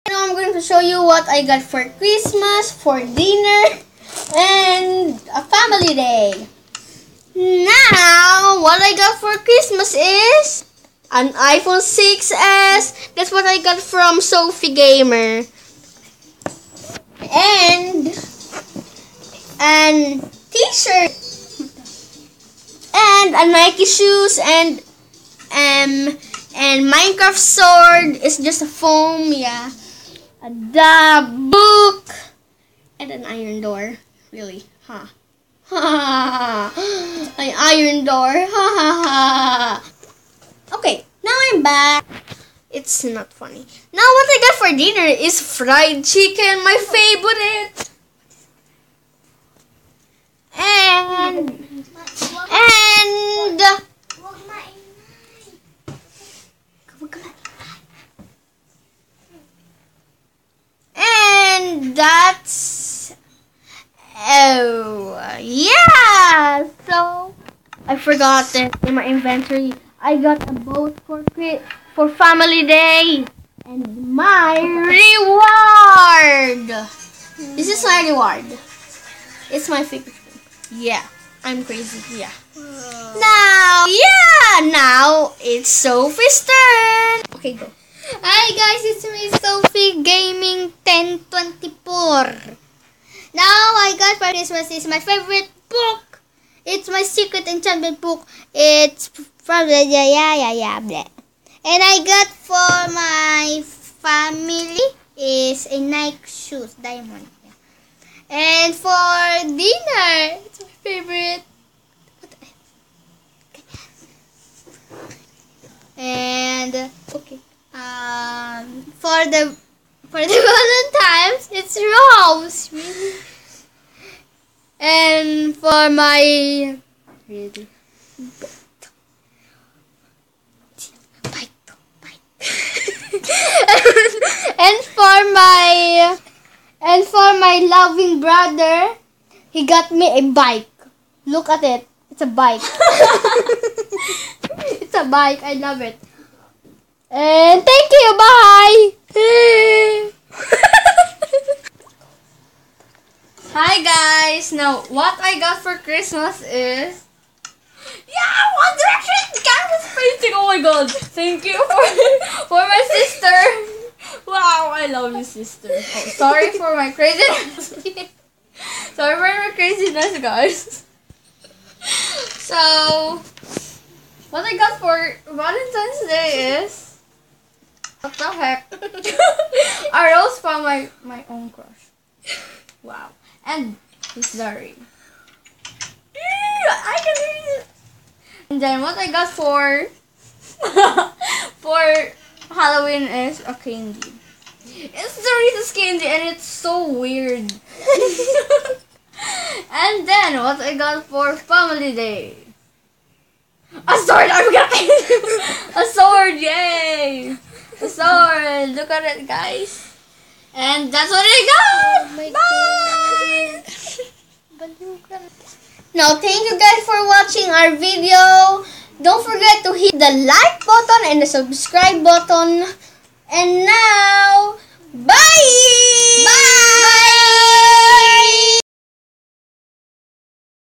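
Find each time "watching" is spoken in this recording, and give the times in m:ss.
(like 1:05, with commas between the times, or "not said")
3:37.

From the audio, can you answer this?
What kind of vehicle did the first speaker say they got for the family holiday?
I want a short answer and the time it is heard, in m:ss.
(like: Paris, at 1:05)
A boat, at 1:10.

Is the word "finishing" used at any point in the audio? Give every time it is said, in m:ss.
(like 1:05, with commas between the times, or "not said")
not said.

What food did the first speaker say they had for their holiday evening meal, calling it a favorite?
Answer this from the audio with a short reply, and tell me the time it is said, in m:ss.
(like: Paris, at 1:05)
Fried chicken, at 0:45.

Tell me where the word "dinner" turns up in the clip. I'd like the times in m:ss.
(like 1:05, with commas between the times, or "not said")
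0:02, 0:44, 1:49.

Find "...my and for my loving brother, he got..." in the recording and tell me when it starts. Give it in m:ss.
2:15.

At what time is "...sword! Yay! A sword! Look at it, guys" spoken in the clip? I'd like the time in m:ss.
3:25.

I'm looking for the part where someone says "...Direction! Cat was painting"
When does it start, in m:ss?
2:38.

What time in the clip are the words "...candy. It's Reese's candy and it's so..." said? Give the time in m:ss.
3:13.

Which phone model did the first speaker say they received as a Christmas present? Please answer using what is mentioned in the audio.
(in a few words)
iPhone 6S.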